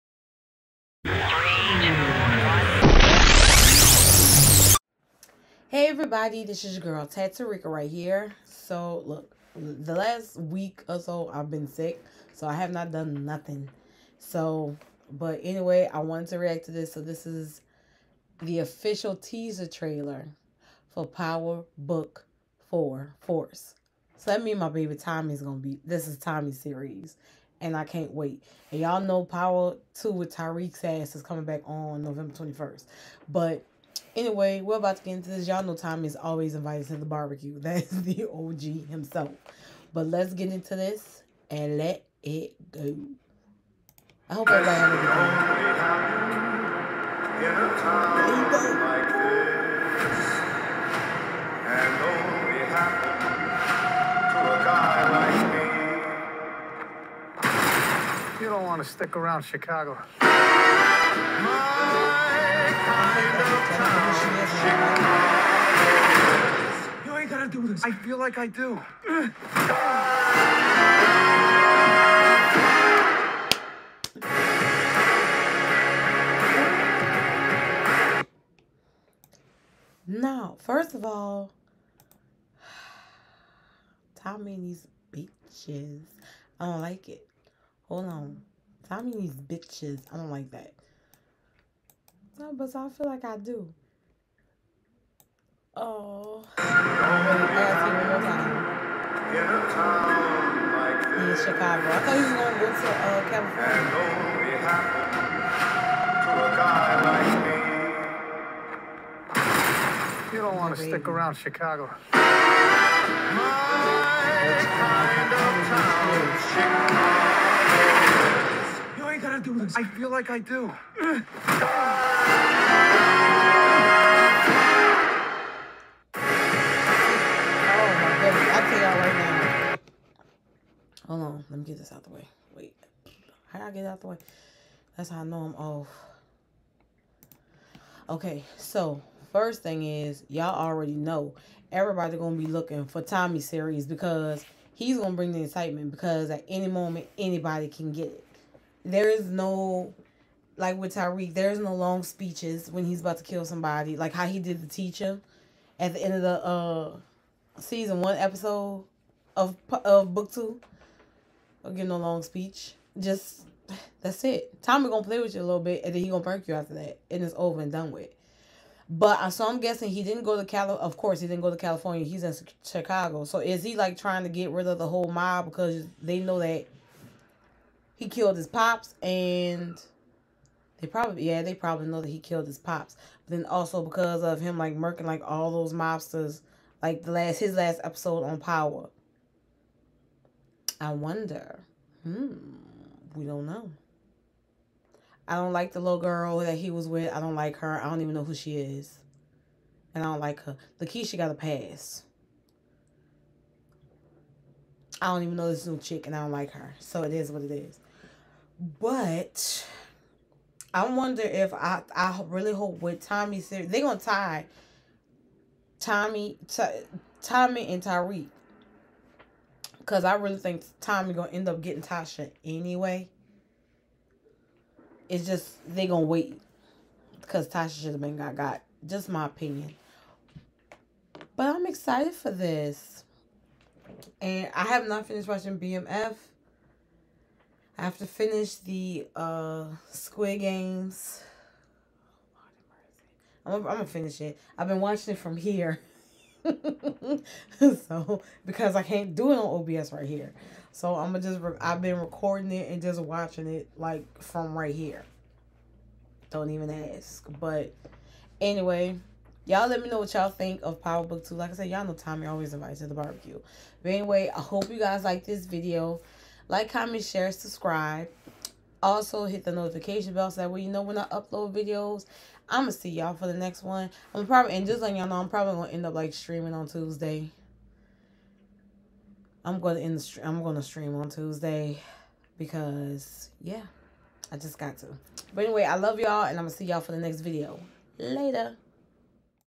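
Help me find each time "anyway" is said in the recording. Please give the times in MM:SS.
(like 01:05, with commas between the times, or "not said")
00:15, 00:34, 03:42, 04:18, 04:23, 04:45.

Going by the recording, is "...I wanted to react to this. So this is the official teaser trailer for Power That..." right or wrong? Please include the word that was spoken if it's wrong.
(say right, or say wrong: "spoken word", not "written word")
wrong: "Book", not "That".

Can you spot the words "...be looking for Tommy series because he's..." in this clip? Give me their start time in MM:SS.
02:22.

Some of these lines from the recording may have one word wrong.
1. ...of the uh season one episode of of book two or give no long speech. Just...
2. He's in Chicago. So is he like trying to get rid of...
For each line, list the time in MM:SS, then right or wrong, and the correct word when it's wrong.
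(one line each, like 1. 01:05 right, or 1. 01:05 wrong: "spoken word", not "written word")
1. 02:36 right
2. 02:52 right.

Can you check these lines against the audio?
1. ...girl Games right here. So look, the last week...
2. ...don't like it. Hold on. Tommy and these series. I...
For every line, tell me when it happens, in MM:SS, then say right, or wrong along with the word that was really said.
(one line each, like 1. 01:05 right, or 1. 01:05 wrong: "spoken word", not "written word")
1. 00:06 wrong: "TattooRika", not "Games"
2. 01:26 wrong: "bitches", not "series".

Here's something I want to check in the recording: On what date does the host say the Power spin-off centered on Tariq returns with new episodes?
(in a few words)
November 21st.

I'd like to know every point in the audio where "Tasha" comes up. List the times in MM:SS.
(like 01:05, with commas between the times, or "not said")
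03:41, 03:47.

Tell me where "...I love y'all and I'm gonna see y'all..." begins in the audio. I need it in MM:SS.
04:45.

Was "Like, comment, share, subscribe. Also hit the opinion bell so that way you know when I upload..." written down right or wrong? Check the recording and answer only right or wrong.
wrong.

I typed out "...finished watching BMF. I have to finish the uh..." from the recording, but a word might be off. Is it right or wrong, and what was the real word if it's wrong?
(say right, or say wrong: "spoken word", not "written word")
right.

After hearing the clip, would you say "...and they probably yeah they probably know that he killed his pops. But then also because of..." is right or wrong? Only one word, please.
right.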